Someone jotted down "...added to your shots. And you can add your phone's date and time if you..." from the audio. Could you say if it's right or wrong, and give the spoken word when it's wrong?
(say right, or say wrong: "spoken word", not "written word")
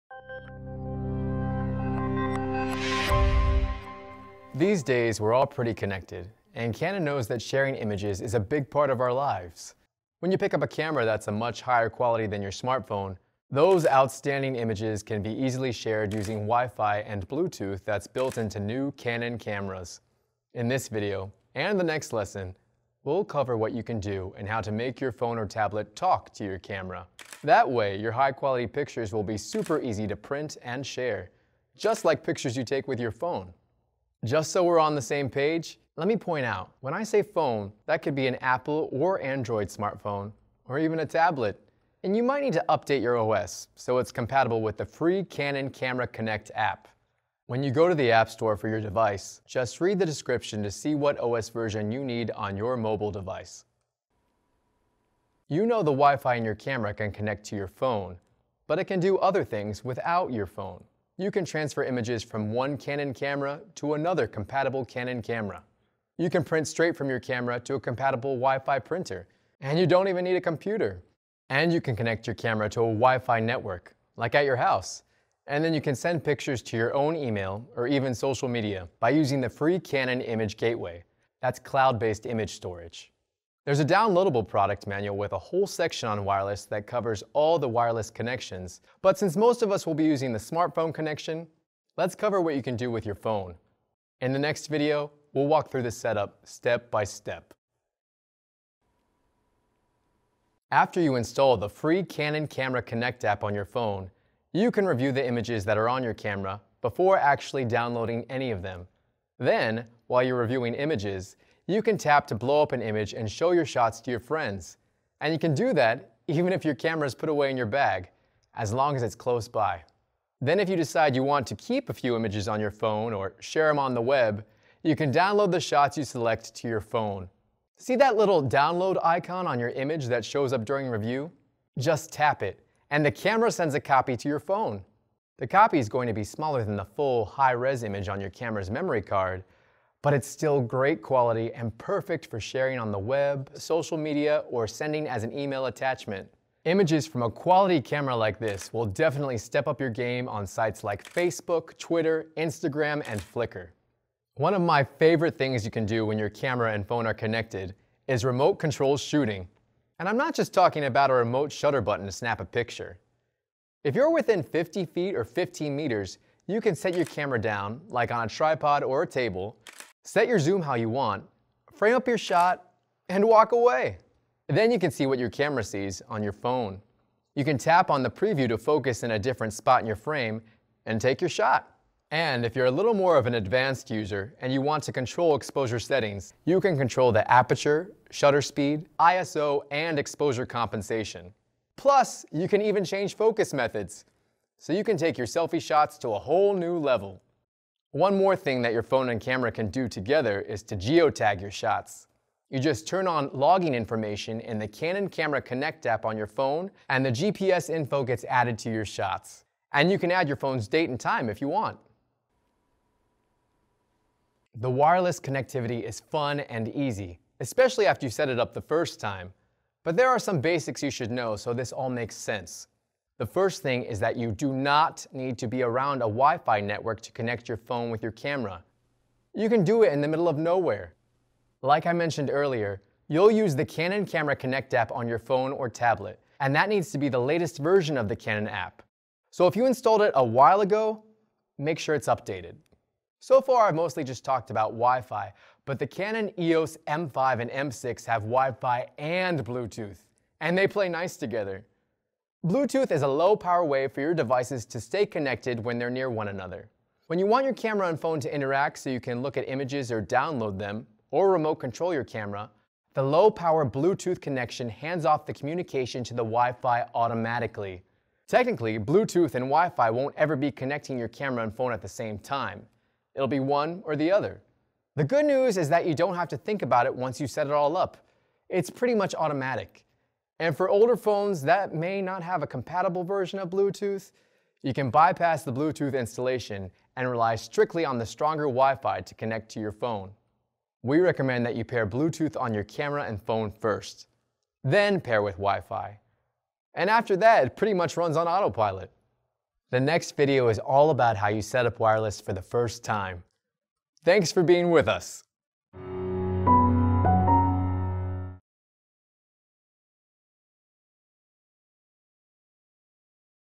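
right.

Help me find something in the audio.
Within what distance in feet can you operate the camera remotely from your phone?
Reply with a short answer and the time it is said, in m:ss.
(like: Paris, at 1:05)
50 feet, at 2:44.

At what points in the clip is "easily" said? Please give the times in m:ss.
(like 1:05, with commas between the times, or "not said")
0:15.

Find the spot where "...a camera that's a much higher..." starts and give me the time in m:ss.
0:10.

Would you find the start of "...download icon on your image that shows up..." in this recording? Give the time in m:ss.
2:08.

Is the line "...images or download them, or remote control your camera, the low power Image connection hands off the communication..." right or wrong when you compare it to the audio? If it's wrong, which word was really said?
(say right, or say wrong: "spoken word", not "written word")
wrong: "Bluetooth", not "Image".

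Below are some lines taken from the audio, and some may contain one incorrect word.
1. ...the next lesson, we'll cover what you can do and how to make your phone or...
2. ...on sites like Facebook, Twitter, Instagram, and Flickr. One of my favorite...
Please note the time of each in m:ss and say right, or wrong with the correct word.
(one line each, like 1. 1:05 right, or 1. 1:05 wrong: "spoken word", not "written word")
1. 0:21 right
2. 2:30 right.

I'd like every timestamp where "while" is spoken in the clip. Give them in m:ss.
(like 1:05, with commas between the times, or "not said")
1:50, 4:00.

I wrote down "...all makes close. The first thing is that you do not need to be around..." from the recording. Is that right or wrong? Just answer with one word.
wrong.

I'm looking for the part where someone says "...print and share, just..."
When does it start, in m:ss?
0:30.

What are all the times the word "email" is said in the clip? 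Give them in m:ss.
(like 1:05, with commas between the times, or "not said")
1:17, 2:25.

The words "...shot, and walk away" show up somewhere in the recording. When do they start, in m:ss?
2:52.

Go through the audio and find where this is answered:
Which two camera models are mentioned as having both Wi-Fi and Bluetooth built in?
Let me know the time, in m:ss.
4:06.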